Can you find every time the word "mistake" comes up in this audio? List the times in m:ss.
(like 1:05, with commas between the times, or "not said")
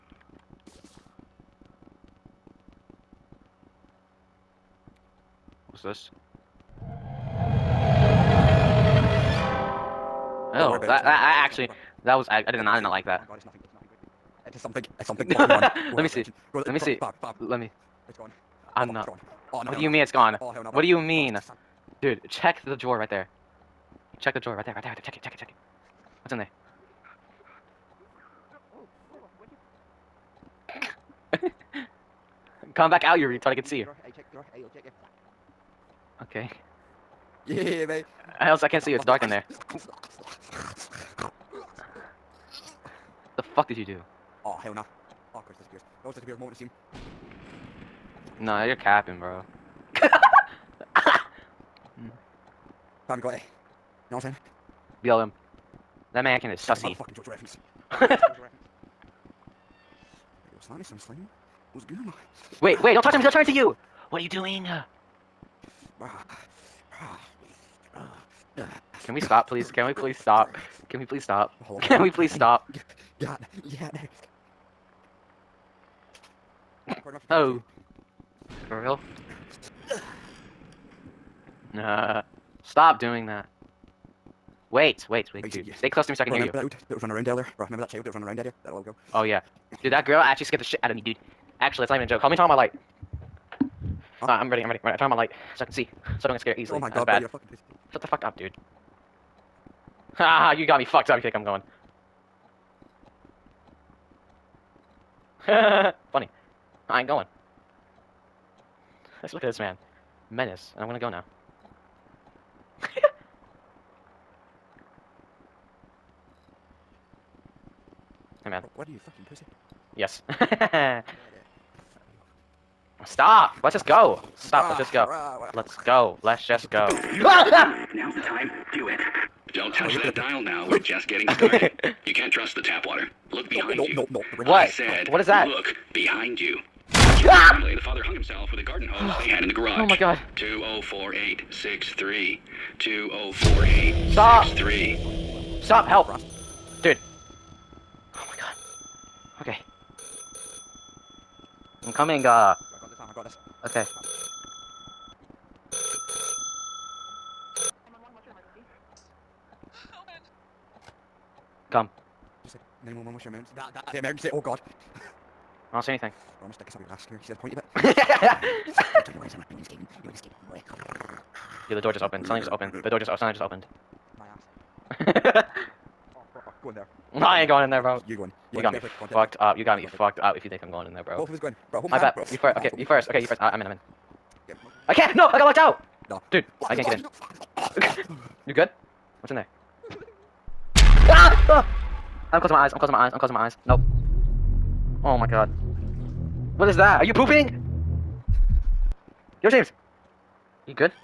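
not said.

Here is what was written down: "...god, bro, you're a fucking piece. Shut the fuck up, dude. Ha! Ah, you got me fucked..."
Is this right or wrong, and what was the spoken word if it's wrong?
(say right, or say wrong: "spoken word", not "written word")
right.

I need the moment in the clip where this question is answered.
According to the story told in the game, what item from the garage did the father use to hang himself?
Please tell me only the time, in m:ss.
2:18.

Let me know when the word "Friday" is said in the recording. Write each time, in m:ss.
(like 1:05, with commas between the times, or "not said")
not said.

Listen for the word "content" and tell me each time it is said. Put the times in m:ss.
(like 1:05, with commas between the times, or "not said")
2:59.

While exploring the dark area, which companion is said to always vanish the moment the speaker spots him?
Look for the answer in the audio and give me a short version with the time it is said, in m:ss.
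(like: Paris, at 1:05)
Chris, at 0:45.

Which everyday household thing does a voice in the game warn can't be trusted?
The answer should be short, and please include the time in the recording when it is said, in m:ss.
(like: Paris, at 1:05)
The tap water, at 2:12.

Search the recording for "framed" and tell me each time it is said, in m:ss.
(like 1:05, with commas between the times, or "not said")
not said.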